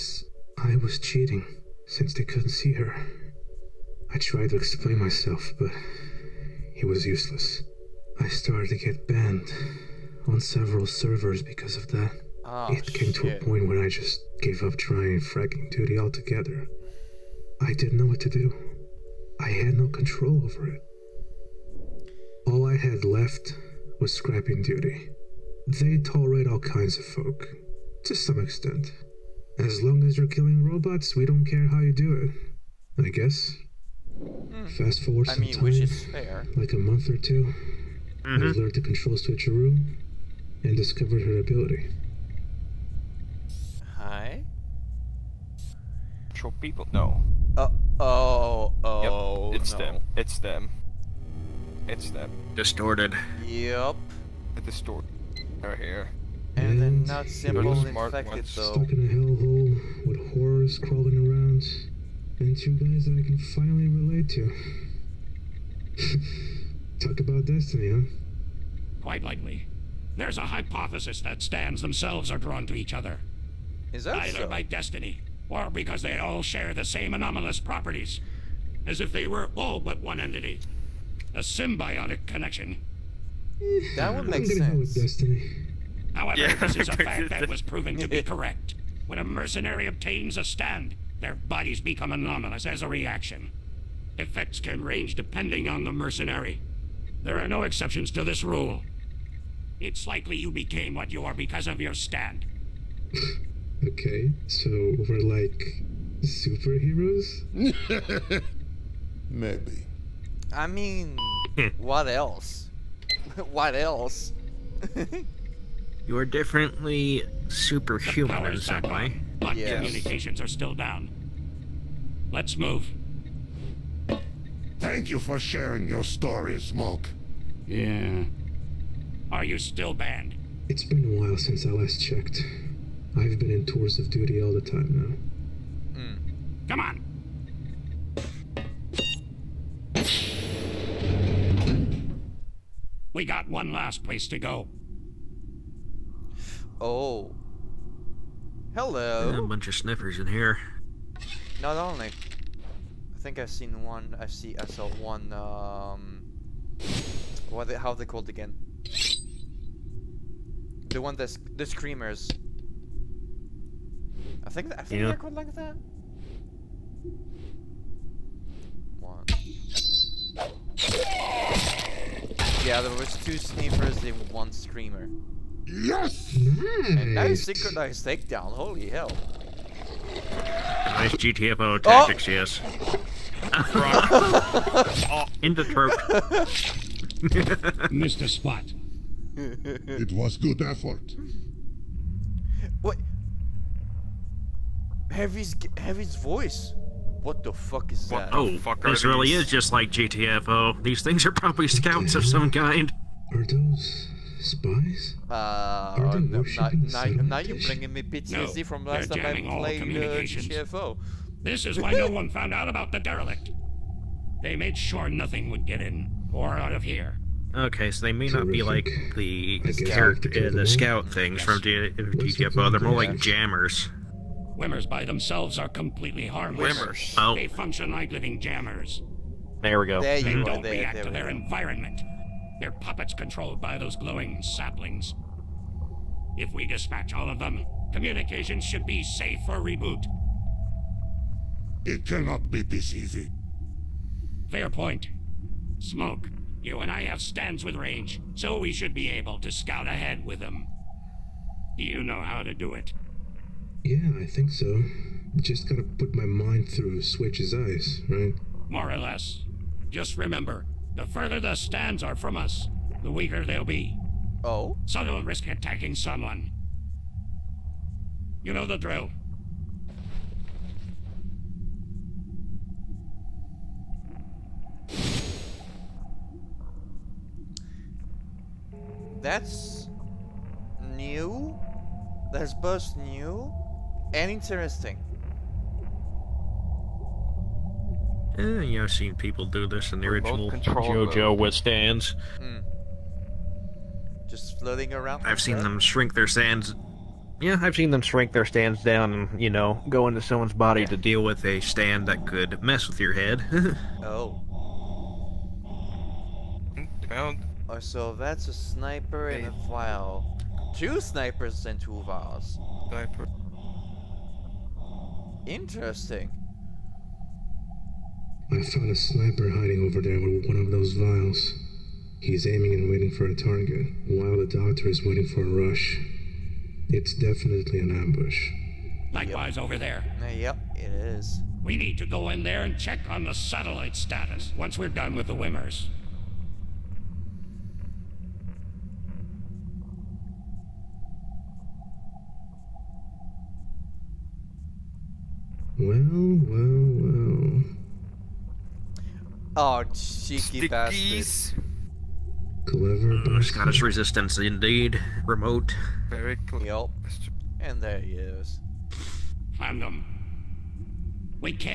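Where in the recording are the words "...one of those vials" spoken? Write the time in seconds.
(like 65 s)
320 s.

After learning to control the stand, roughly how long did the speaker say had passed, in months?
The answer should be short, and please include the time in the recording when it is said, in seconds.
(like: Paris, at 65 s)
1 or 2 months, at 36 s.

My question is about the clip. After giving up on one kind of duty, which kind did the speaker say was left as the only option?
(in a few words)
Scrapping duty.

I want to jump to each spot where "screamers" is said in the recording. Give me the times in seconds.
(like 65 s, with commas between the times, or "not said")
161 s, 174 s.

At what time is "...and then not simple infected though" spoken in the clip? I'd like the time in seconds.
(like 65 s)
56 s.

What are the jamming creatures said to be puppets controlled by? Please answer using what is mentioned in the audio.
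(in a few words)
Glowing saplings.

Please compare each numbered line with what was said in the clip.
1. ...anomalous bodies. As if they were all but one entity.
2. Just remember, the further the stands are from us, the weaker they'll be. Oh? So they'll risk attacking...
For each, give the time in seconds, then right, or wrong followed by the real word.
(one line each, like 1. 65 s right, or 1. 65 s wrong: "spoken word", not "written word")
1. 77 s wrong: "properties", not "bodies"
2. 259 s right.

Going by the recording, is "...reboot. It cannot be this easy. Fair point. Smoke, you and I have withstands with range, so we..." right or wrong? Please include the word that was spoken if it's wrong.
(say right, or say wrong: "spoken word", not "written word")
wrong: "stands", not "withstands".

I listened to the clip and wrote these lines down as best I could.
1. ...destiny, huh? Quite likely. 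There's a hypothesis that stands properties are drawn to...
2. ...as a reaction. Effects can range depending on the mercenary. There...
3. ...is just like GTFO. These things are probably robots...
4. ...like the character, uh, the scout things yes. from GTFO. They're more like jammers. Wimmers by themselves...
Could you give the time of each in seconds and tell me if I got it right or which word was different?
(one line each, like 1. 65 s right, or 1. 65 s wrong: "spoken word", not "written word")
1. 67 s wrong: "themselves", not "properties"
2. 92 s right
3. 199 s wrong: "scouts", not "robots"
4. 218 s right.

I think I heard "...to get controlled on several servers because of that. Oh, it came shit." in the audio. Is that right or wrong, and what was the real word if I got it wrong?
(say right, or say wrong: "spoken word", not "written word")
wrong: "banned", not "controlled".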